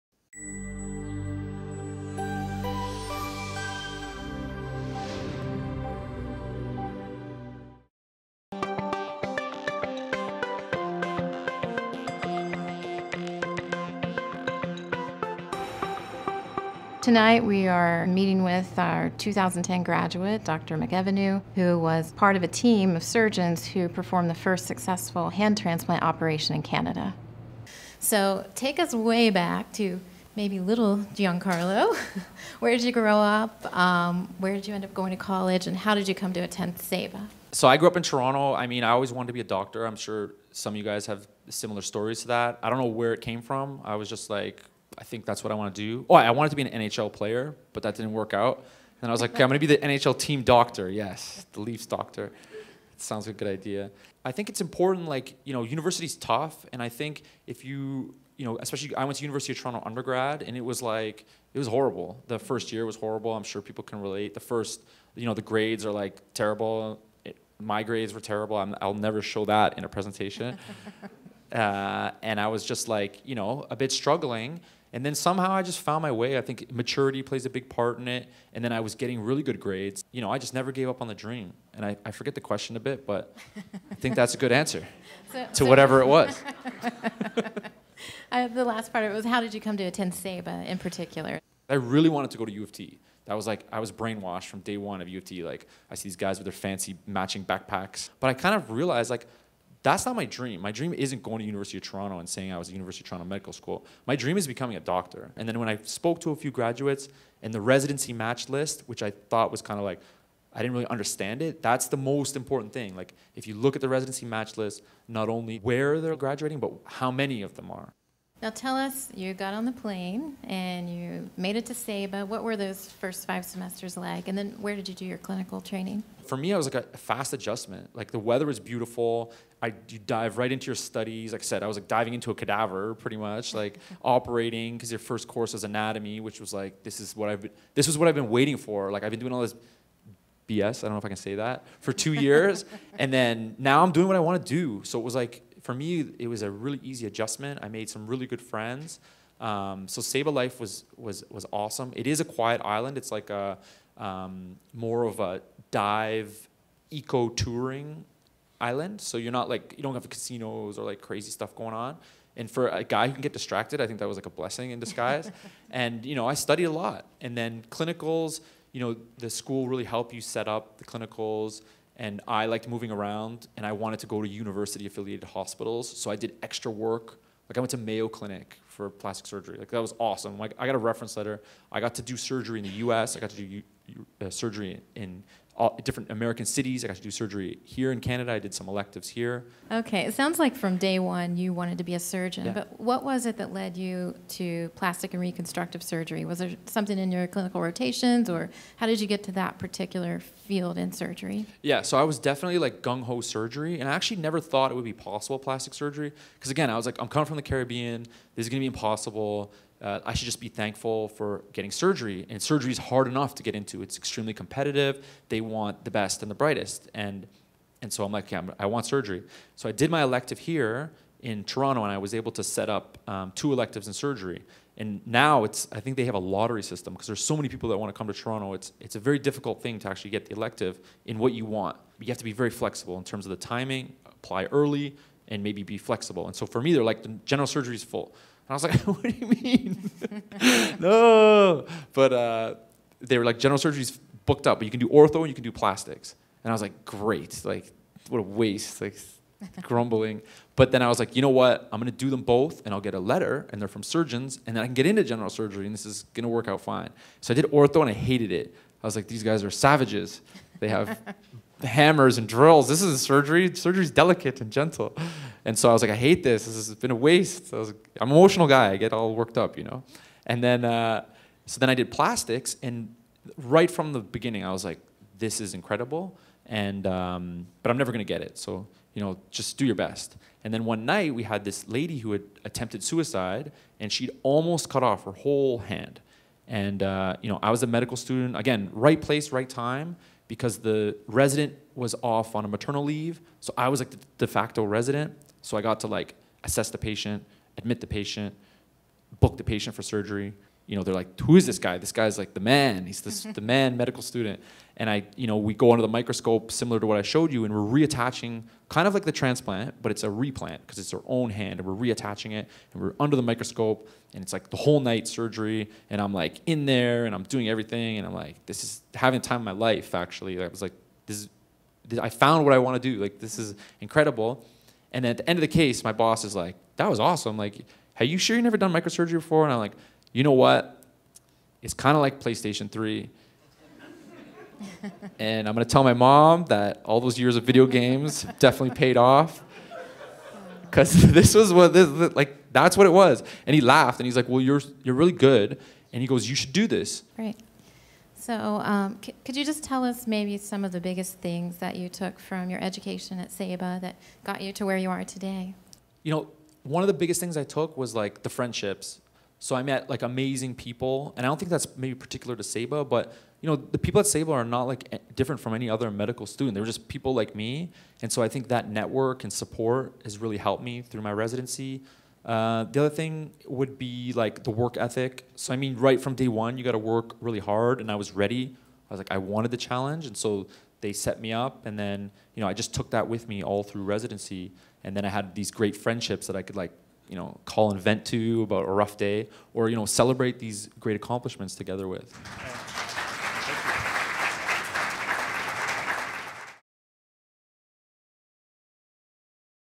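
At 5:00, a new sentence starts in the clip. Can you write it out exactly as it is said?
You know, they're like, who is this guy?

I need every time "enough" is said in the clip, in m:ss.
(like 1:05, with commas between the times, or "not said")
3:33.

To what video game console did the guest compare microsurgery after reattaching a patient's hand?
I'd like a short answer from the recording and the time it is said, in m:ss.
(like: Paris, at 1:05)
PlayStation 3, at 5:32.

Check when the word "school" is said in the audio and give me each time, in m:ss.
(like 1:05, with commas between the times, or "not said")
1:43, 2:49.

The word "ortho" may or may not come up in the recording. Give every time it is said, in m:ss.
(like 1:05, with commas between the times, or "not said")
4:04, 4:17.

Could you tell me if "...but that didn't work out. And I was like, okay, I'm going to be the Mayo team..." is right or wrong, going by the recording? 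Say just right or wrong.
wrong.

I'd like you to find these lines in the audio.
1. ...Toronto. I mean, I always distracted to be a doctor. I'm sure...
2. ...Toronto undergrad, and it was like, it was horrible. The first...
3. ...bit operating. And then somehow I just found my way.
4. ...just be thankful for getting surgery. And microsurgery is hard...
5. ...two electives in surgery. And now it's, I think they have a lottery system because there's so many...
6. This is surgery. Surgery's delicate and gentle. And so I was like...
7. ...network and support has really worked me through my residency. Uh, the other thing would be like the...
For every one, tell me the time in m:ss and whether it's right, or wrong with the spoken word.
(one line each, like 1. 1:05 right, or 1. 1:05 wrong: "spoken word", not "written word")
1. 0:38 wrong: "wanted", not "distracted"
2. 0:59 right
3. 1:13 wrong: "struggling", not "operating"
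4. 3:30 wrong: "surgery", not "microsurgery"
5. 3:43 right
6. 4:22 right
7. 6:08 wrong: "helped", not "worked".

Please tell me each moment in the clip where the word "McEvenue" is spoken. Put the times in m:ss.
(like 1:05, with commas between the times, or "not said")
0:20.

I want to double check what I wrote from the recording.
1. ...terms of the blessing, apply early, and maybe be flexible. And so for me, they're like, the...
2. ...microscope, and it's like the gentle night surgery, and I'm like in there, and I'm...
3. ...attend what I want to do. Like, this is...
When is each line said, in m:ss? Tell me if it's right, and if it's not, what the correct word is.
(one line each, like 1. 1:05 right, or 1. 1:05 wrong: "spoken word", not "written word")
1. 3:53 wrong: "timing", not "blessing"
2. 5:13 wrong: "whole", not "gentle"
3. 5:22 wrong: "found", not "attend".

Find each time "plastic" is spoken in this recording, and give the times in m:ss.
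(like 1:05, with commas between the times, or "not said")
2:58, 3:14, 3:25, 4:05, 4:31.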